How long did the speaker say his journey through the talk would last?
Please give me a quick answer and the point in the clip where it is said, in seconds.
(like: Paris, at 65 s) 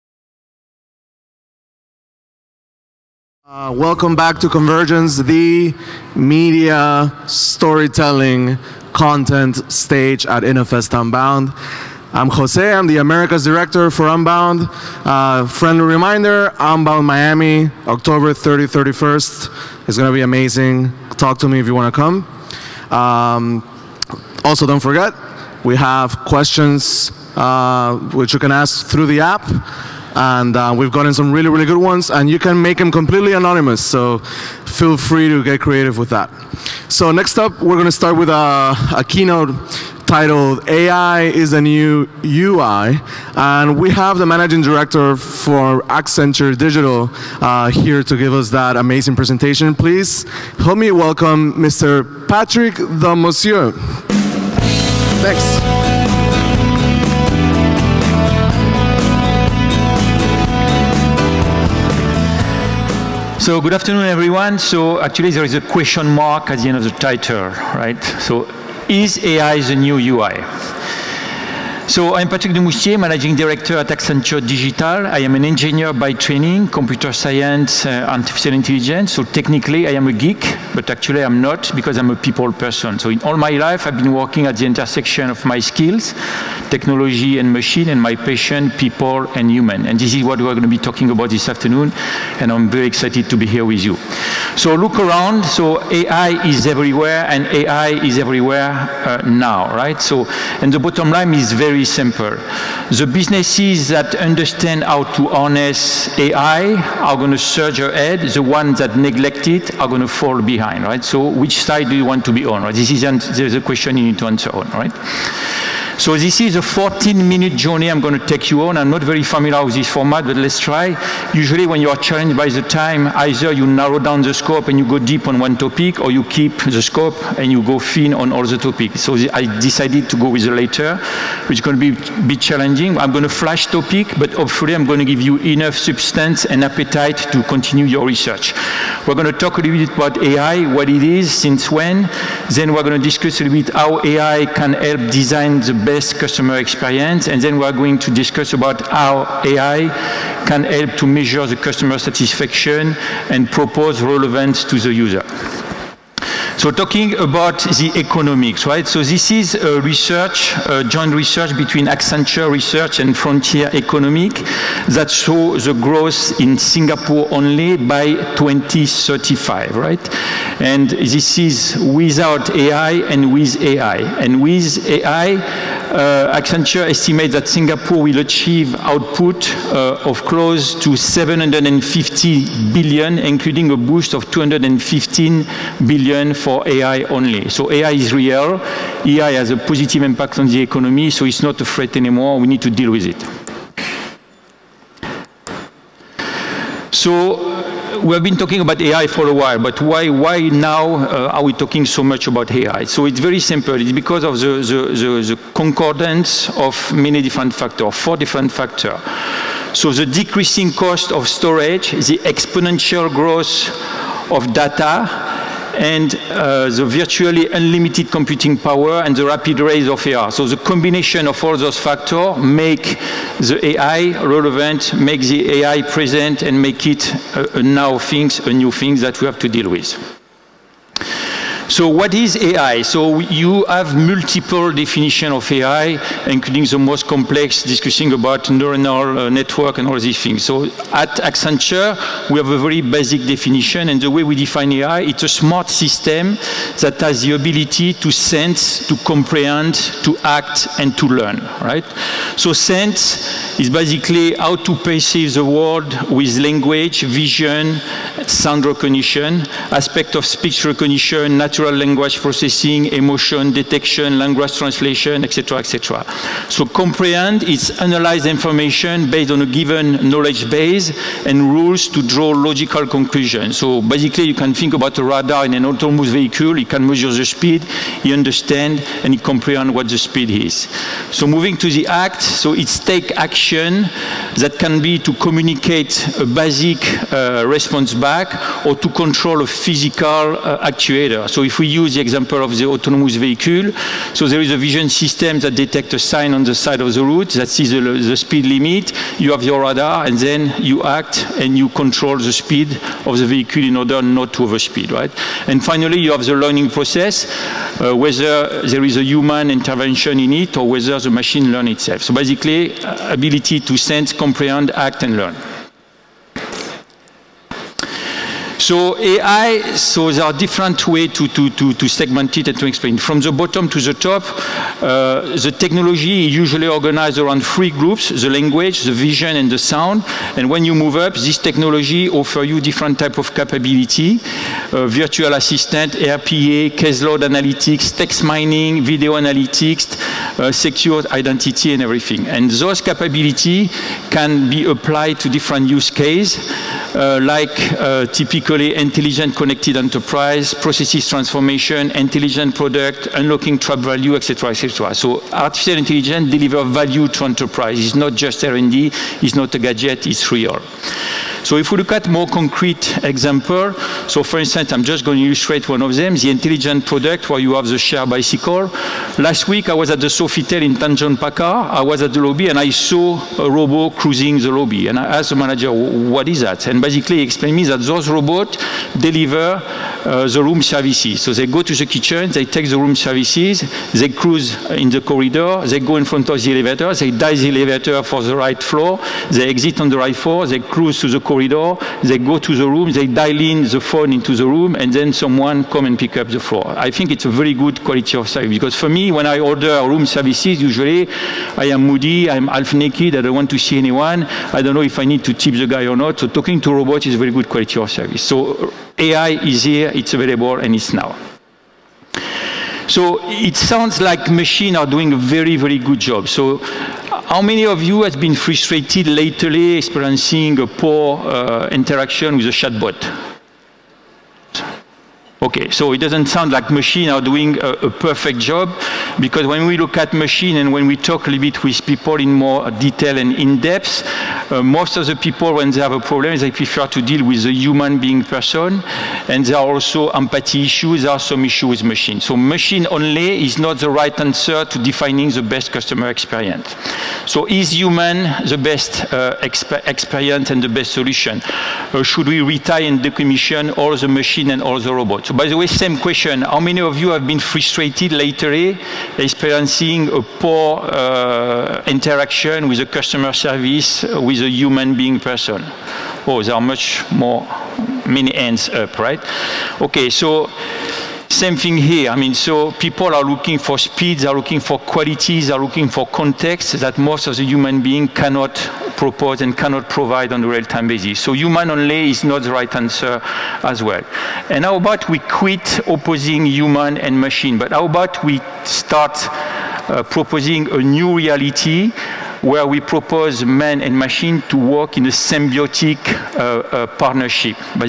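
14 minutes, at 116 s.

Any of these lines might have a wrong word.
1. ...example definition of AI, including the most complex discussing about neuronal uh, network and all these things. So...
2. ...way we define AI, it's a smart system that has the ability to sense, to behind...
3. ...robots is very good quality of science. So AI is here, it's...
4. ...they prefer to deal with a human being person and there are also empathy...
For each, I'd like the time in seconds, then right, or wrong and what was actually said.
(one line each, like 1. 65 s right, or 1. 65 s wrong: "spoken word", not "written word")
1. 233 s wrong: "multiple", not "example"
2. 244 s wrong: "comprehend", not "behind"
3. 406 s wrong: "service", not "science"
4. 436 s right.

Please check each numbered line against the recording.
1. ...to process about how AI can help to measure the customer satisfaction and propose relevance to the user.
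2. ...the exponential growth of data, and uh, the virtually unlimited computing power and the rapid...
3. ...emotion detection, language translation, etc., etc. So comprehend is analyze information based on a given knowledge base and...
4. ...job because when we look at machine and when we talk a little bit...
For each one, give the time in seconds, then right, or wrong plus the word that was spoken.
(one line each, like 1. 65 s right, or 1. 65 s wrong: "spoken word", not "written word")
1. 147 s wrong: "discuss", not "process"
2. 211 s right
3. 262 s right
4. 428 s right.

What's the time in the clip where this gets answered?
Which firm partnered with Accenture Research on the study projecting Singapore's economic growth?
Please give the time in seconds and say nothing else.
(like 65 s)
163 s.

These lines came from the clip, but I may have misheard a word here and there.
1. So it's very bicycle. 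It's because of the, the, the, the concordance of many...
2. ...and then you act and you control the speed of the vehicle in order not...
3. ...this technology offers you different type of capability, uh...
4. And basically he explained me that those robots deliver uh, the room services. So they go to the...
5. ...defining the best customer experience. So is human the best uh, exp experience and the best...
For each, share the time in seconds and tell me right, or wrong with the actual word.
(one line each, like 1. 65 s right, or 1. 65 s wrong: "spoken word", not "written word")
1. 202 s wrong: "simple", not "bicycle"
2. 300 s right
3. 331 s right
4. 376 s right
5. 444 s right.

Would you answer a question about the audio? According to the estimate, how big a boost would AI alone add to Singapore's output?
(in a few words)
215 billion.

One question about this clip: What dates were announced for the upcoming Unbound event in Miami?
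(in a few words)
October 30, 31.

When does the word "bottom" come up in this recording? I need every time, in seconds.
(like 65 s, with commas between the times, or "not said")
100 s, 323 s.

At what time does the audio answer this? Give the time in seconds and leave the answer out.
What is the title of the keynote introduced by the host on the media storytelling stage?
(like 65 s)
40 s.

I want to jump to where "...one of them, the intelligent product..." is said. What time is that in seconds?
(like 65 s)
365 s.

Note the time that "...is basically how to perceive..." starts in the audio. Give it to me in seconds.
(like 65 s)
253 s.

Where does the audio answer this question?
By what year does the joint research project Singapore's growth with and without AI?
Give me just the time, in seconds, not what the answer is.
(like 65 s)
168 s.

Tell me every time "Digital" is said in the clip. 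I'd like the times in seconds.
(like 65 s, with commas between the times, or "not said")
46 s, 74 s.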